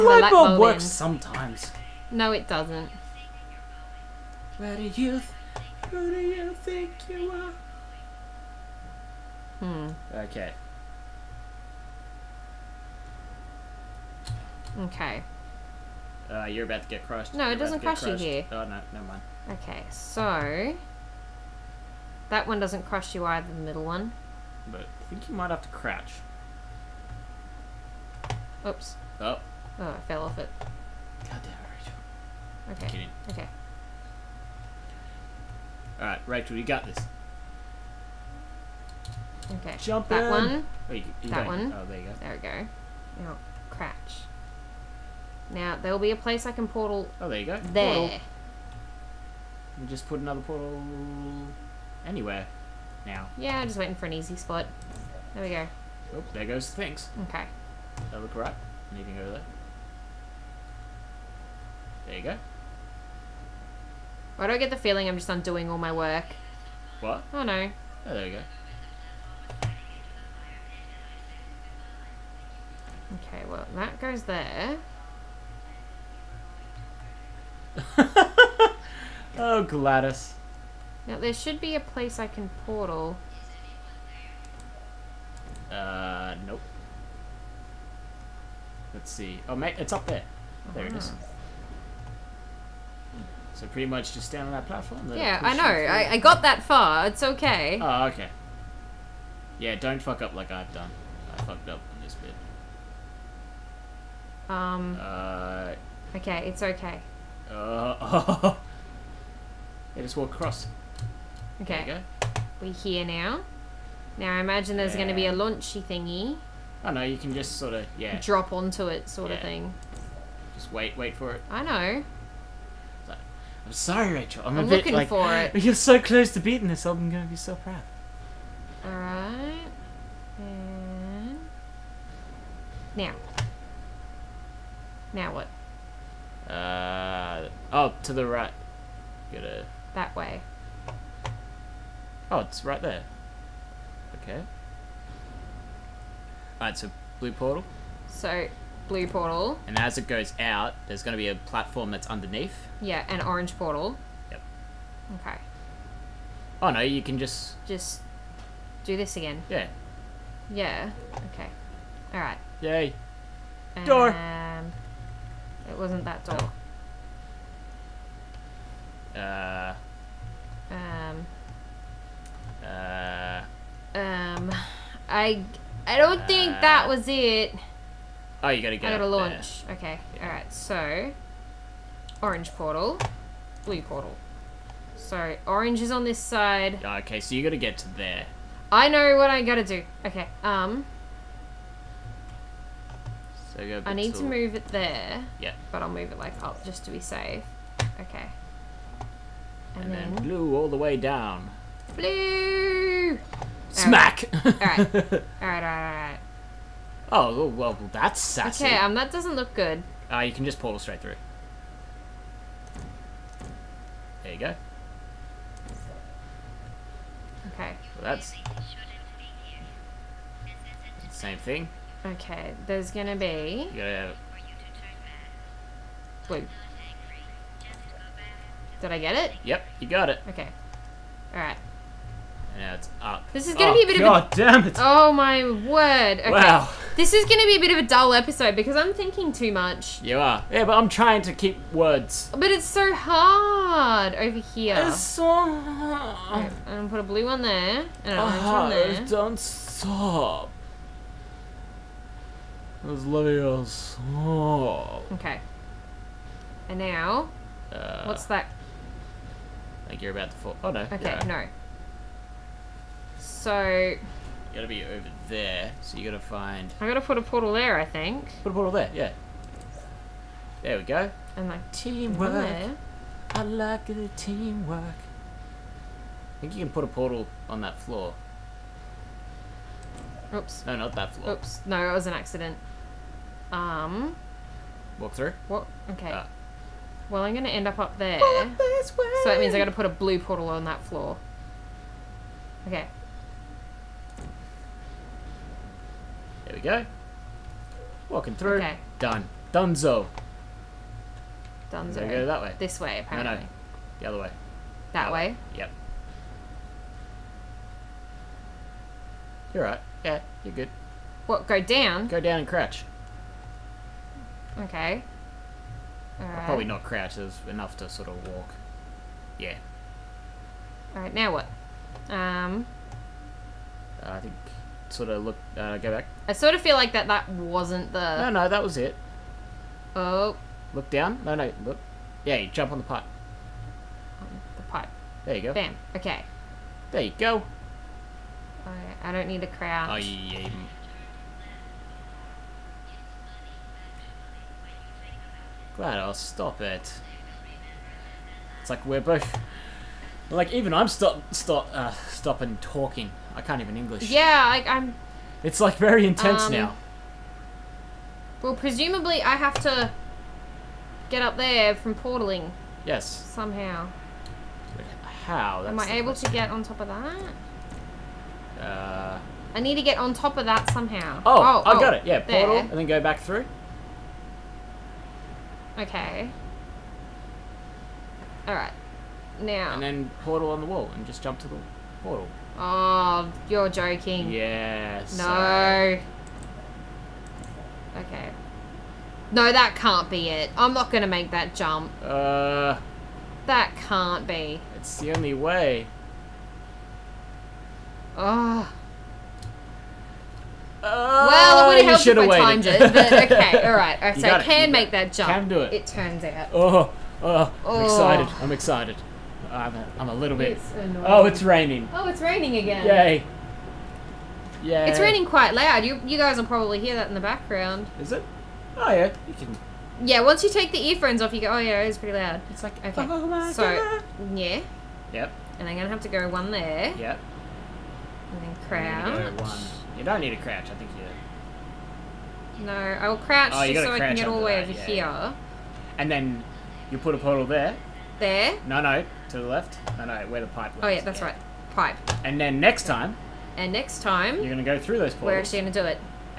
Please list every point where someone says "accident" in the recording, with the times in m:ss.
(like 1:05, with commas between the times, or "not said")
4:42.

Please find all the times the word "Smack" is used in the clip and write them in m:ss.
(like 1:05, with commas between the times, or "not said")
3:23.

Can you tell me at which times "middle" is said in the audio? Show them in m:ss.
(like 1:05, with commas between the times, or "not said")
0:23.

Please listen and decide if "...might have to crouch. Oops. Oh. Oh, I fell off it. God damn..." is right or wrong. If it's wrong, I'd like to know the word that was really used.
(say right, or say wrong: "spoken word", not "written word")
right.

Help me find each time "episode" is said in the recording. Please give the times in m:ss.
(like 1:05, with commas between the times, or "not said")
3:58.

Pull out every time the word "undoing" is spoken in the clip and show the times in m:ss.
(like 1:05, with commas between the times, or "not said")
1:05.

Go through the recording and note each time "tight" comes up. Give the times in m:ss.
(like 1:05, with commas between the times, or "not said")
not said.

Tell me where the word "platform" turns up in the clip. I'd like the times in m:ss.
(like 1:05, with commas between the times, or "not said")
1:34, 2:31.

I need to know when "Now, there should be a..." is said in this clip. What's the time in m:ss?
1:21.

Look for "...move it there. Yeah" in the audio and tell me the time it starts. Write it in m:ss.
3:14.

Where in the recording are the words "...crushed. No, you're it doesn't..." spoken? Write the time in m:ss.
0:17.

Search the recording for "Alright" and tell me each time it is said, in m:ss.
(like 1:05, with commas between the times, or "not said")
2:26, 2:42, 3:51, 5:20, 6:18.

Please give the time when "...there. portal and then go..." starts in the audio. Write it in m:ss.
6:12.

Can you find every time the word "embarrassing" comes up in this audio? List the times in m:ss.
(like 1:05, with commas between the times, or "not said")
not said.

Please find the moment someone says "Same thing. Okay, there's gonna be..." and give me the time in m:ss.
3:41.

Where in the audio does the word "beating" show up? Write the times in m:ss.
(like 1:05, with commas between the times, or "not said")
2:06.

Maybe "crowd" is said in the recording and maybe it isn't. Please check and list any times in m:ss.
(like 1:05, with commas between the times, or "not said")
5:39.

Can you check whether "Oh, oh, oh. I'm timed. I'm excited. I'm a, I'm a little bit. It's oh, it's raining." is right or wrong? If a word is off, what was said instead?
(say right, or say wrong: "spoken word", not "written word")
wrong: "excited", not "timed".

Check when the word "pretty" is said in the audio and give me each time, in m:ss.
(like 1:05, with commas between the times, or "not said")
1:33, 7:01.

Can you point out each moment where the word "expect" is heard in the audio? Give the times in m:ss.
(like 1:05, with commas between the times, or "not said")
not said.